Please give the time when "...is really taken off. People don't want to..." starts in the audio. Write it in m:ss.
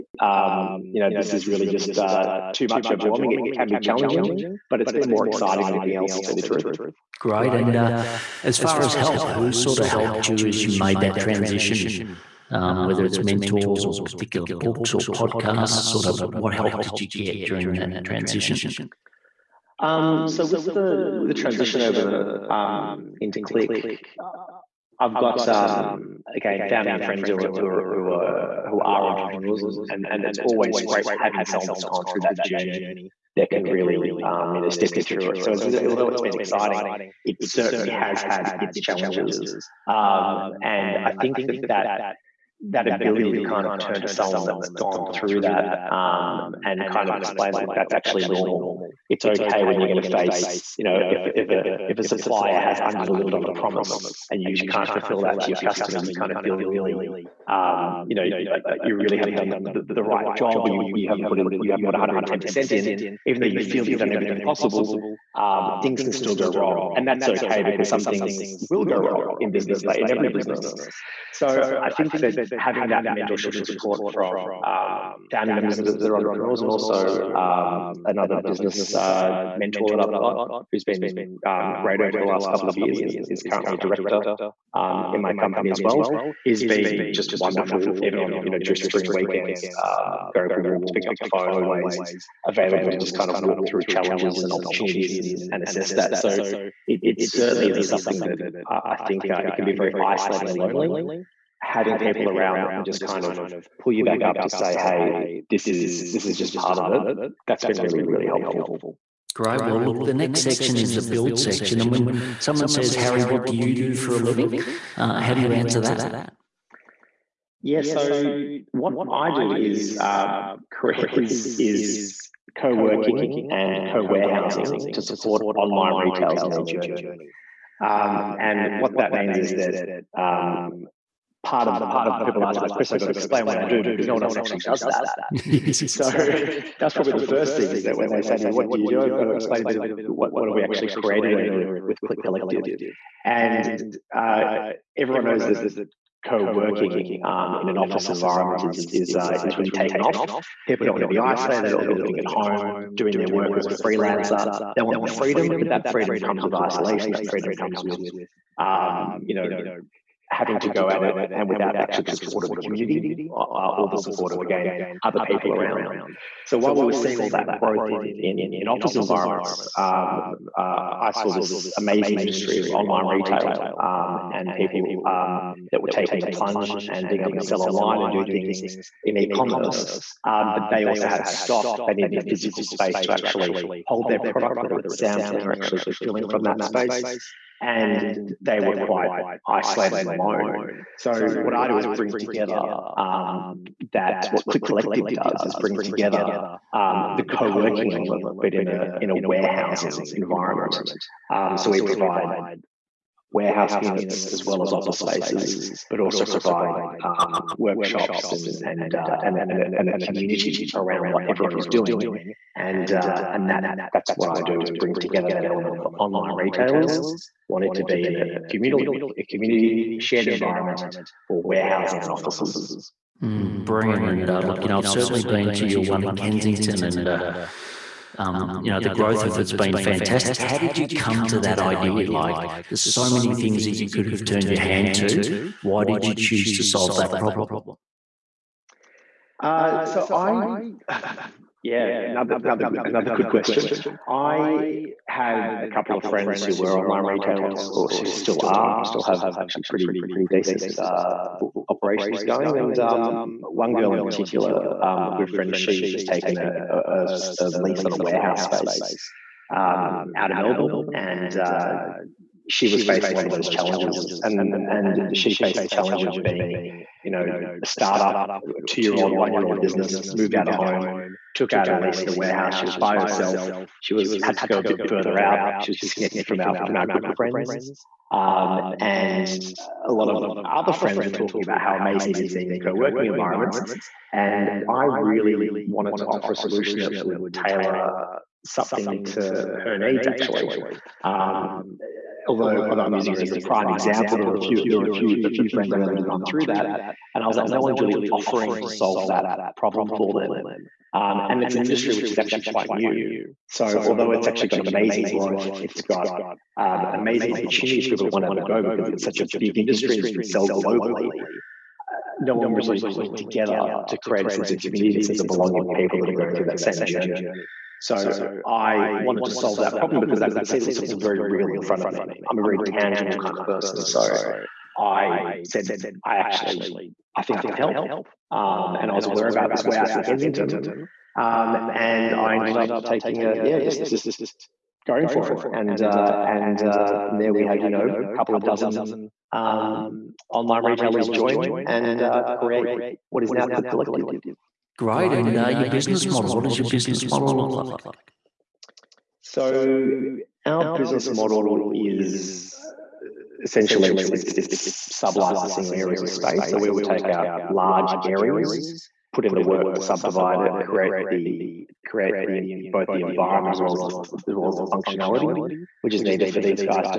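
2:29.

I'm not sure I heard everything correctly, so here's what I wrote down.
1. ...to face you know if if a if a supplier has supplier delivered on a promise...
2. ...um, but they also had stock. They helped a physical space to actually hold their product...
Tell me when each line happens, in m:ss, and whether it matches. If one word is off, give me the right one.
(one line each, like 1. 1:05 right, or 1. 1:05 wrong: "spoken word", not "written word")
1. 0:50 wrong: "under", not "supplier"
2. 3:00 wrong: "needed", not "helped".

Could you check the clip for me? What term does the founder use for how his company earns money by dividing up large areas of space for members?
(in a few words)
sub-licensing.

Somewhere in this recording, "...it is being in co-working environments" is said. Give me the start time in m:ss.
4:42.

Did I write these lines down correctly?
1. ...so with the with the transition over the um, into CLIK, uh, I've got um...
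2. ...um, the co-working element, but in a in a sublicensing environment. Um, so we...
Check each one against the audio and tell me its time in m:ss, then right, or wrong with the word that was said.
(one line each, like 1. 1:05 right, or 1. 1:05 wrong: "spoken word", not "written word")
1. 0:20 right
2. 3:16 wrong: "warehousing", not "sublicensing".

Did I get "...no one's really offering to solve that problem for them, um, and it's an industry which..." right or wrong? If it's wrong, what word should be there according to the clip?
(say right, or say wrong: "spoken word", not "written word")
right.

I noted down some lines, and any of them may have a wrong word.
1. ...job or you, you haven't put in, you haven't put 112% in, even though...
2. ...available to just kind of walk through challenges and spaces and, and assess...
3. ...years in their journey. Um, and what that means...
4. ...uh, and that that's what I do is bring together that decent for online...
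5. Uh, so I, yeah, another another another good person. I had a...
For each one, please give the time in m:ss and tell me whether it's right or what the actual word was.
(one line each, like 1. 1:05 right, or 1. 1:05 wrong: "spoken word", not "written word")
1. 1:00 wrong: "110", not "112"
2. 1:32 wrong: "opportunities", not "spaces"
3. 2:05 wrong: "retailers", not "years"
4. 3:32 wrong: "element", not "decent"
5. 3:59 wrong: "question", not "person".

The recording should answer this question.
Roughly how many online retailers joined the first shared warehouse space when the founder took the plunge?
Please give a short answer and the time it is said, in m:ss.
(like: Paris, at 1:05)
a couple of dozen, at 5:37.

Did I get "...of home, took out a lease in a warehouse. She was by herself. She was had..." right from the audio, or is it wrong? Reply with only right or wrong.
right.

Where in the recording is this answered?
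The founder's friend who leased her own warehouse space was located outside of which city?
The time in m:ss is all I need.
4:20.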